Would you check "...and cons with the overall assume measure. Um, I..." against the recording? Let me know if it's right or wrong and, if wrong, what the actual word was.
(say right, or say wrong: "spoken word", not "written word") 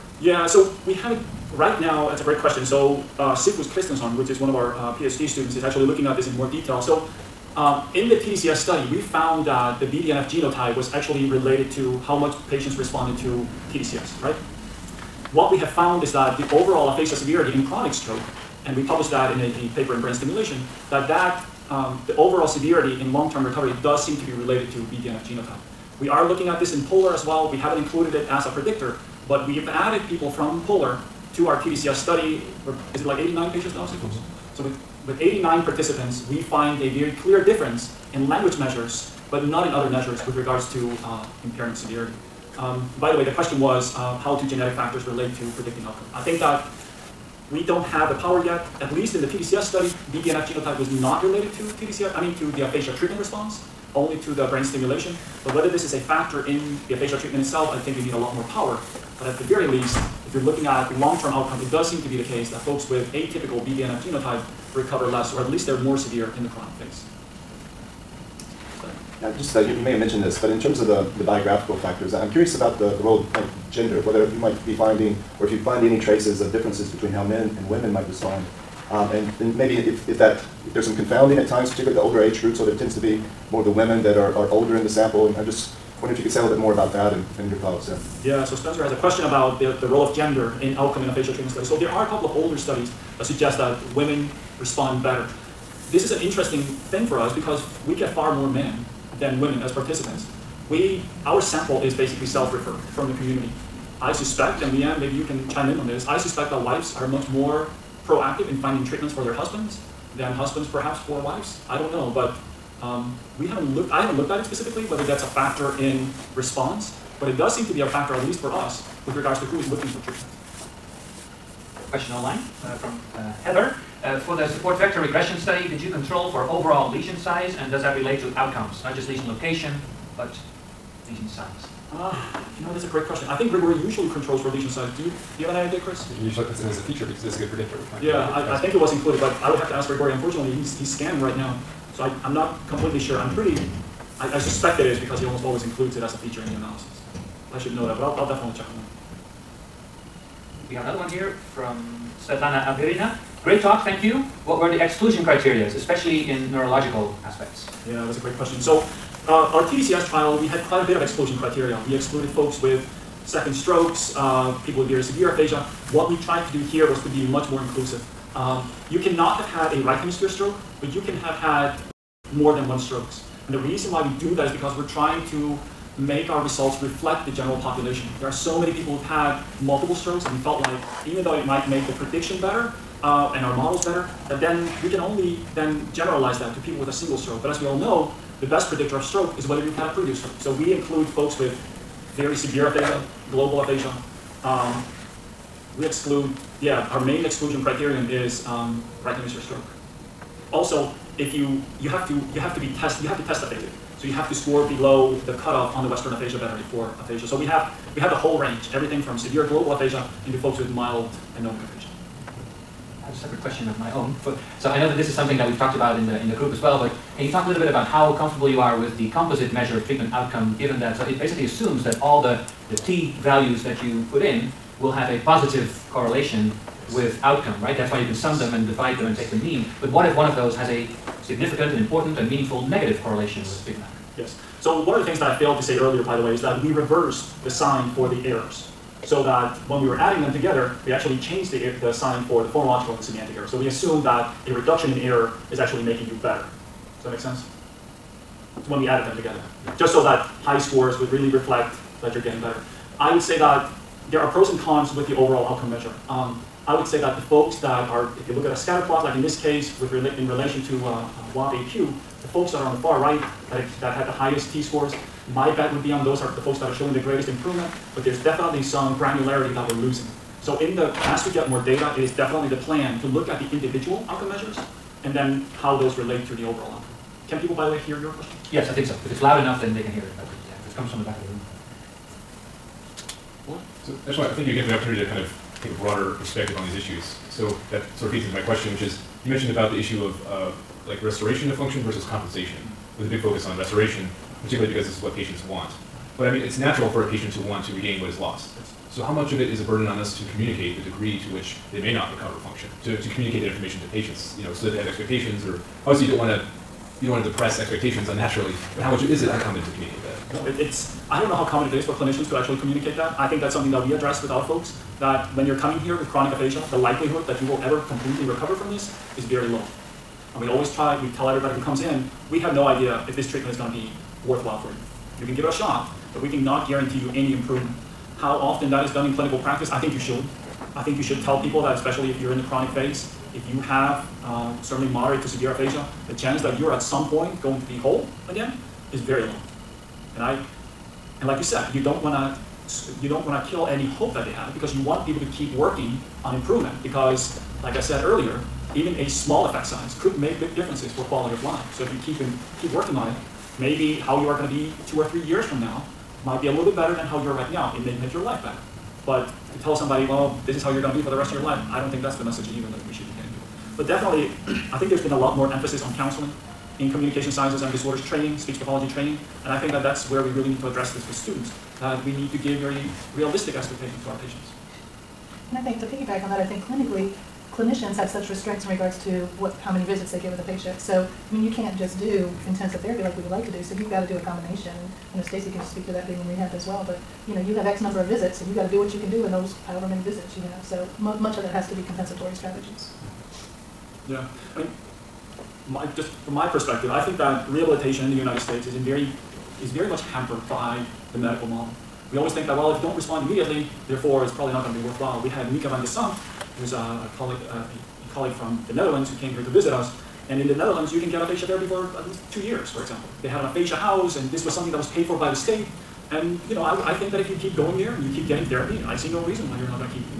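wrong: "outcome", not "assume".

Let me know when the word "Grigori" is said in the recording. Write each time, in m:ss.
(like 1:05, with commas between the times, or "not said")
2:13, 2:19.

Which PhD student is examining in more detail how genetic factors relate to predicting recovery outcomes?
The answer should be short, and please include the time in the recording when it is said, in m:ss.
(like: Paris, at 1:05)
Sigfus Kristinsson, at 0:03.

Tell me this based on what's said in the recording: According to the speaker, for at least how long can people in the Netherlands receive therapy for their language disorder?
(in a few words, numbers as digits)
2 years.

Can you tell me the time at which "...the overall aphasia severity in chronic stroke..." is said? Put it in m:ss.
0:16.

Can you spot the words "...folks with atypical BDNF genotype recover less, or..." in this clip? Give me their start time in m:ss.
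1:02.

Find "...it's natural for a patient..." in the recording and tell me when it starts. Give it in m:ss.
4:56.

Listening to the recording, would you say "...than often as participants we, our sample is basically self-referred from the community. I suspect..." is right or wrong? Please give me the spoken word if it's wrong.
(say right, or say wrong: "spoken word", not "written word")
wrong: "women", not "often".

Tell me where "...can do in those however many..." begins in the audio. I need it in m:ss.
6:28.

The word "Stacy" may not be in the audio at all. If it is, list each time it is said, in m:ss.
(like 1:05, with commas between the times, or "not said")
6:25.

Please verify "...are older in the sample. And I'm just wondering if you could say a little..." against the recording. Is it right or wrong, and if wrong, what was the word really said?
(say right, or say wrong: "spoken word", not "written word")
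right.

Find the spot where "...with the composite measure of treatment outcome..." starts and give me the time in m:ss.
3:38.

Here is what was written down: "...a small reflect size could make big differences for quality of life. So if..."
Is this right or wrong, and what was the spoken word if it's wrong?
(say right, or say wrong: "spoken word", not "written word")
wrong: "effect", not "reflect".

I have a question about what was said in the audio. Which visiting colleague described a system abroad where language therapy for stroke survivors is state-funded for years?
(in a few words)
Mieke van de Sandt.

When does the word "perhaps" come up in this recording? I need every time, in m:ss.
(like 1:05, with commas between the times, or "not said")
1:50.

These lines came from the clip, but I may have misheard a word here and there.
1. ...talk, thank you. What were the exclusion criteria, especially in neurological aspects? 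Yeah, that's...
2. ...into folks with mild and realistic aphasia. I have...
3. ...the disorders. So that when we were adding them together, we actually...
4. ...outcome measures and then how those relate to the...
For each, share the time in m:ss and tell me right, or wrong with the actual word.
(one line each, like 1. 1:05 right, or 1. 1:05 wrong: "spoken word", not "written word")
1. 2:33 right
2. 3:30 wrong: "anomic", not "realistic"
3. 3:58 wrong: "errors", not "disorders"
4. 4:34 right.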